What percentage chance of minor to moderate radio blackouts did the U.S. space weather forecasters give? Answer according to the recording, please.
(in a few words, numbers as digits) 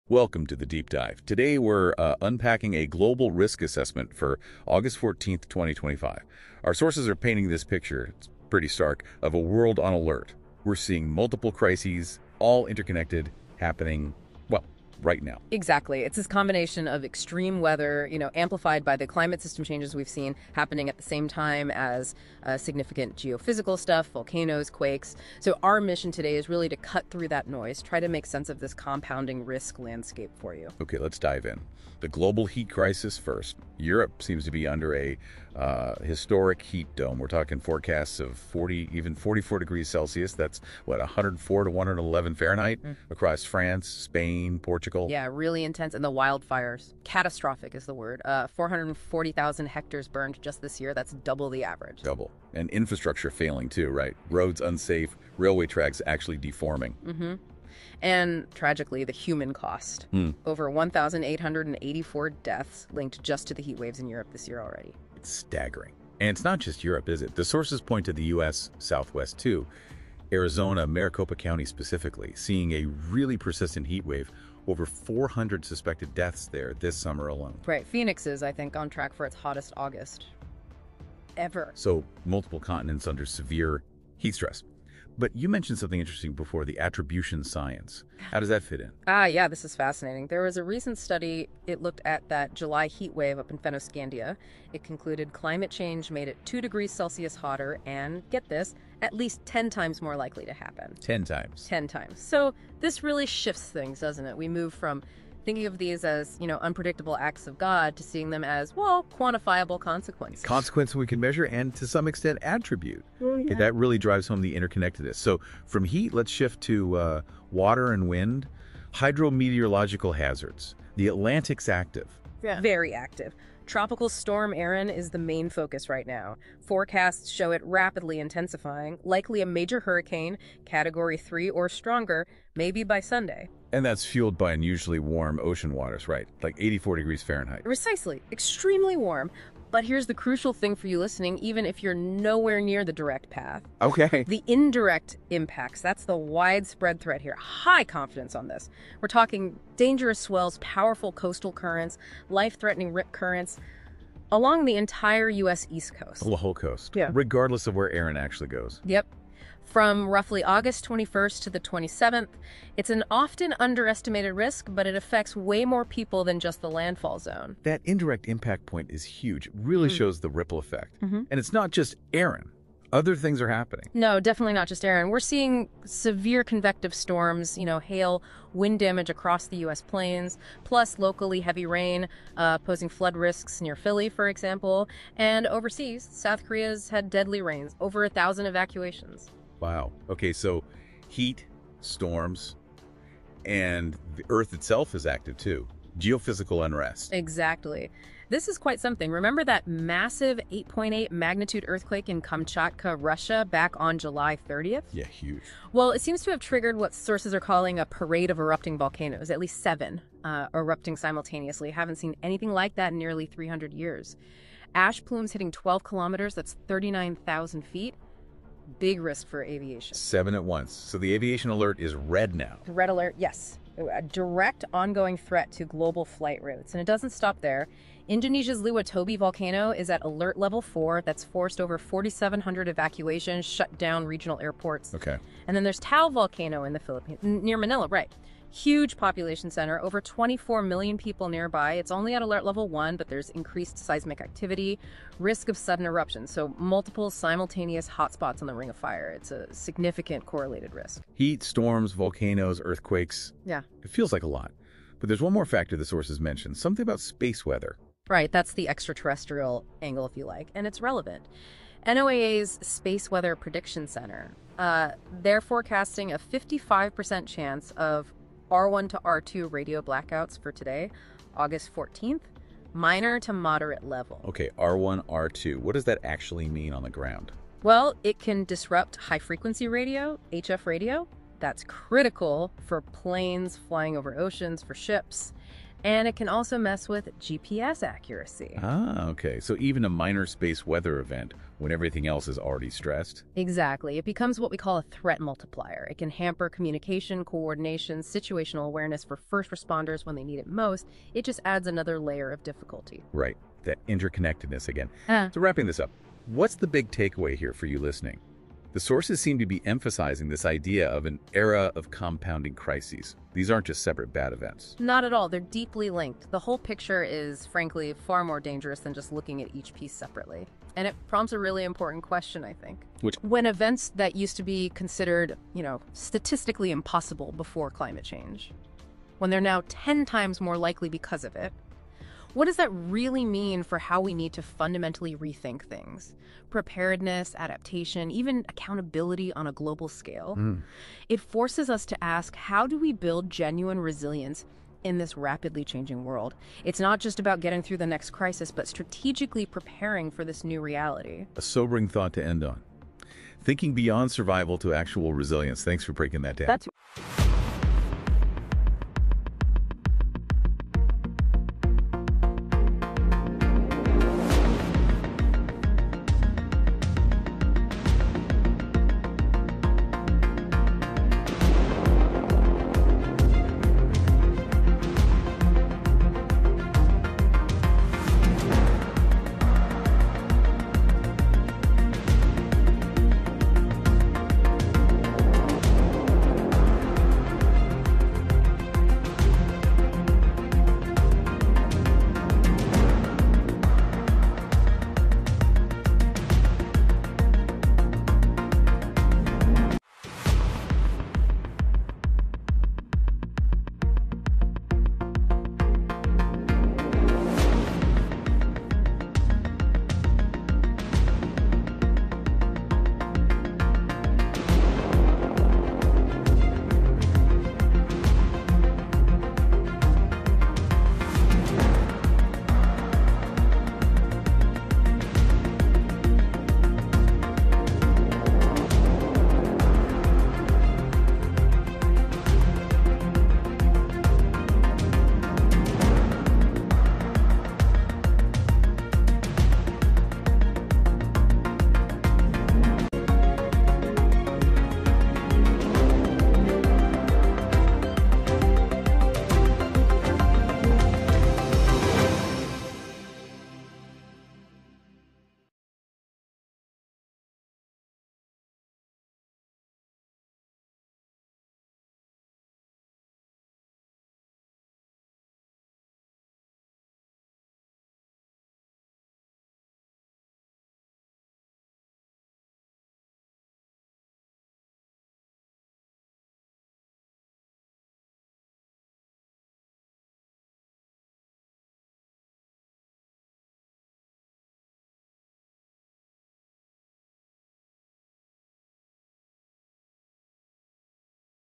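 55%.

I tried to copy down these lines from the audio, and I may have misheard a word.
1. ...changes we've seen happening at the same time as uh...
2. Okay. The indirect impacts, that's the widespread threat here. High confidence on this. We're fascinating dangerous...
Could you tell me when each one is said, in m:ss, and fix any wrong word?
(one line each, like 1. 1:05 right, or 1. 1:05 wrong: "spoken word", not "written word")
1. 0:19 right
2. 2:23 wrong: "talking", not "fascinating".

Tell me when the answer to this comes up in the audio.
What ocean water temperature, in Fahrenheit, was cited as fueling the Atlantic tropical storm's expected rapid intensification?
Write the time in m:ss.
2:16.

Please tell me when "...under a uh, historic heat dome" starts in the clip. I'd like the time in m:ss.
0:34.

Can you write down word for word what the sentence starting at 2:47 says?
That indirect impact point is huge.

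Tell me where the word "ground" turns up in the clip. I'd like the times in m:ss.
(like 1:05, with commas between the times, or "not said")
4:36.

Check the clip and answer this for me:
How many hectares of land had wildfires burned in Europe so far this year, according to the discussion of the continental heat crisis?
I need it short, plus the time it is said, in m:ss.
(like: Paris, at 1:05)
440,000, at 0:48.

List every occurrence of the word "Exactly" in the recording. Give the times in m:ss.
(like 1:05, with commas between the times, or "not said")
0:15, 3:17, 4:53.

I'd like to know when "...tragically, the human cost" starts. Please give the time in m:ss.
0:58.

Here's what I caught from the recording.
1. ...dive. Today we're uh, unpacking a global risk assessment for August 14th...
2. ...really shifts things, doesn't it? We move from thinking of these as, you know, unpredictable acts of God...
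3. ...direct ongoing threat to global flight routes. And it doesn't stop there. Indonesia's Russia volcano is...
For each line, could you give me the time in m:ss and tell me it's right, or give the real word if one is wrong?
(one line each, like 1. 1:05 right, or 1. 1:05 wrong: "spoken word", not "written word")
1. 0:00 right
2. 1:43 right
3. 3:44 wrong: "Lewotobi", not "Russia".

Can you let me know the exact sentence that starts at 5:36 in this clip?
Preparedness, adaptation, even accountability on a global scale.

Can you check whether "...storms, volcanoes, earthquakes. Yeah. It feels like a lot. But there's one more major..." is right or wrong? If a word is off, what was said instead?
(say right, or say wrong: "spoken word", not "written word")
wrong: "factor", not "major".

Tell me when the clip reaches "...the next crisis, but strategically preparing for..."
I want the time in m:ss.
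5:47.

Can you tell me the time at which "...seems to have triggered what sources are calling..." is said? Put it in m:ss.
3:26.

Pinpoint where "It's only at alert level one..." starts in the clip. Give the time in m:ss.
4:01.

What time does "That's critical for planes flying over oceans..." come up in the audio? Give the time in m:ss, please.
4:41.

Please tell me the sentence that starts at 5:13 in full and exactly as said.
These aren't just separate bad events.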